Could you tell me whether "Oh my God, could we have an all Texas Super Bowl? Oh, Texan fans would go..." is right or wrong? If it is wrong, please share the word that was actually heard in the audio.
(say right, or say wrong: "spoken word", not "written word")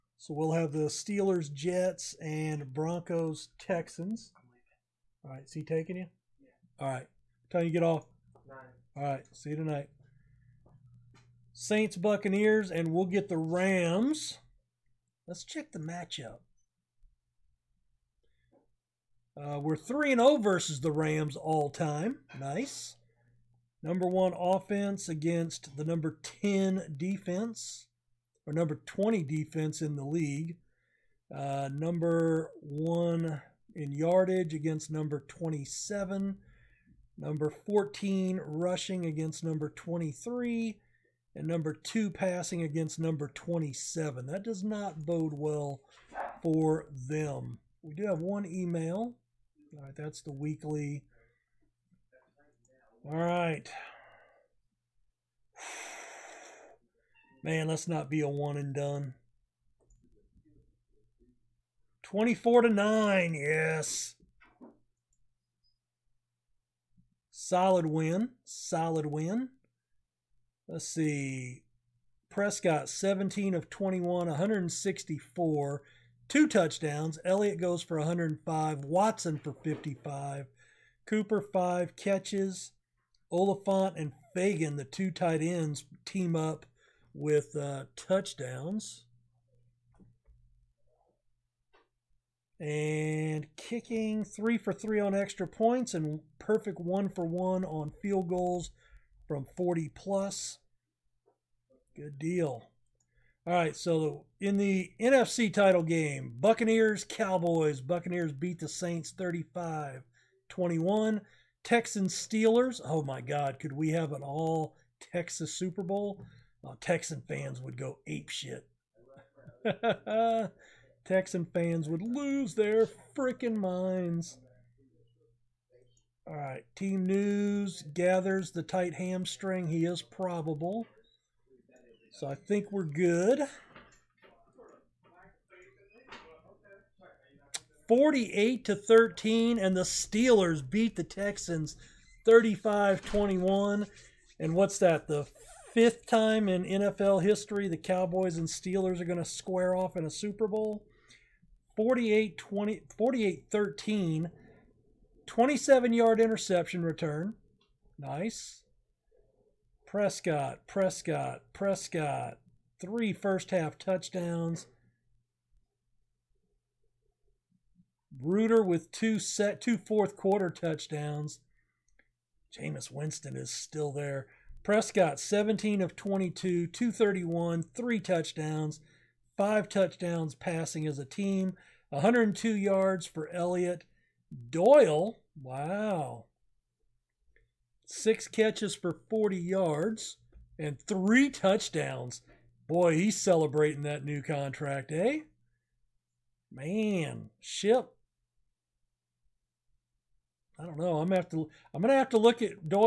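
right.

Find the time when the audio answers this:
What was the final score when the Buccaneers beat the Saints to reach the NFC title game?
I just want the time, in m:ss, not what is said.
1:49.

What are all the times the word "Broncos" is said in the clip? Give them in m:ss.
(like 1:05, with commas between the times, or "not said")
0:02.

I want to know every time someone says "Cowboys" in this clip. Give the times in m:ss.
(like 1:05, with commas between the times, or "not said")
1:47, 2:27.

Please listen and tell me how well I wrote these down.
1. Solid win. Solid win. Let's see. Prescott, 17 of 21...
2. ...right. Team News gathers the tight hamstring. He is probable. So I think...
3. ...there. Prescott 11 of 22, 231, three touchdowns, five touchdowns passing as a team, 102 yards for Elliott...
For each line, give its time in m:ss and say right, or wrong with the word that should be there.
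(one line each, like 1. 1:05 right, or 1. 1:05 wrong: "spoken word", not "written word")
1. 1:07 right
2. 2:06 right
3. 2:53 wrong: "17", not "11".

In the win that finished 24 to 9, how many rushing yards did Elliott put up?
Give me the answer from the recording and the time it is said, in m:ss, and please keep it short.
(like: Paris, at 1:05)
105, at 1:17.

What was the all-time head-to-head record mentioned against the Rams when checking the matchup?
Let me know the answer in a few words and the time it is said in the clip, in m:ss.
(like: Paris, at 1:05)
3-0, at 0:19.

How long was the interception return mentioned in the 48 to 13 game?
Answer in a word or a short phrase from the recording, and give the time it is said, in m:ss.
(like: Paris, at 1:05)
27 yards, at 2:35.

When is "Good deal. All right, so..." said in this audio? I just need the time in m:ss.
1:41.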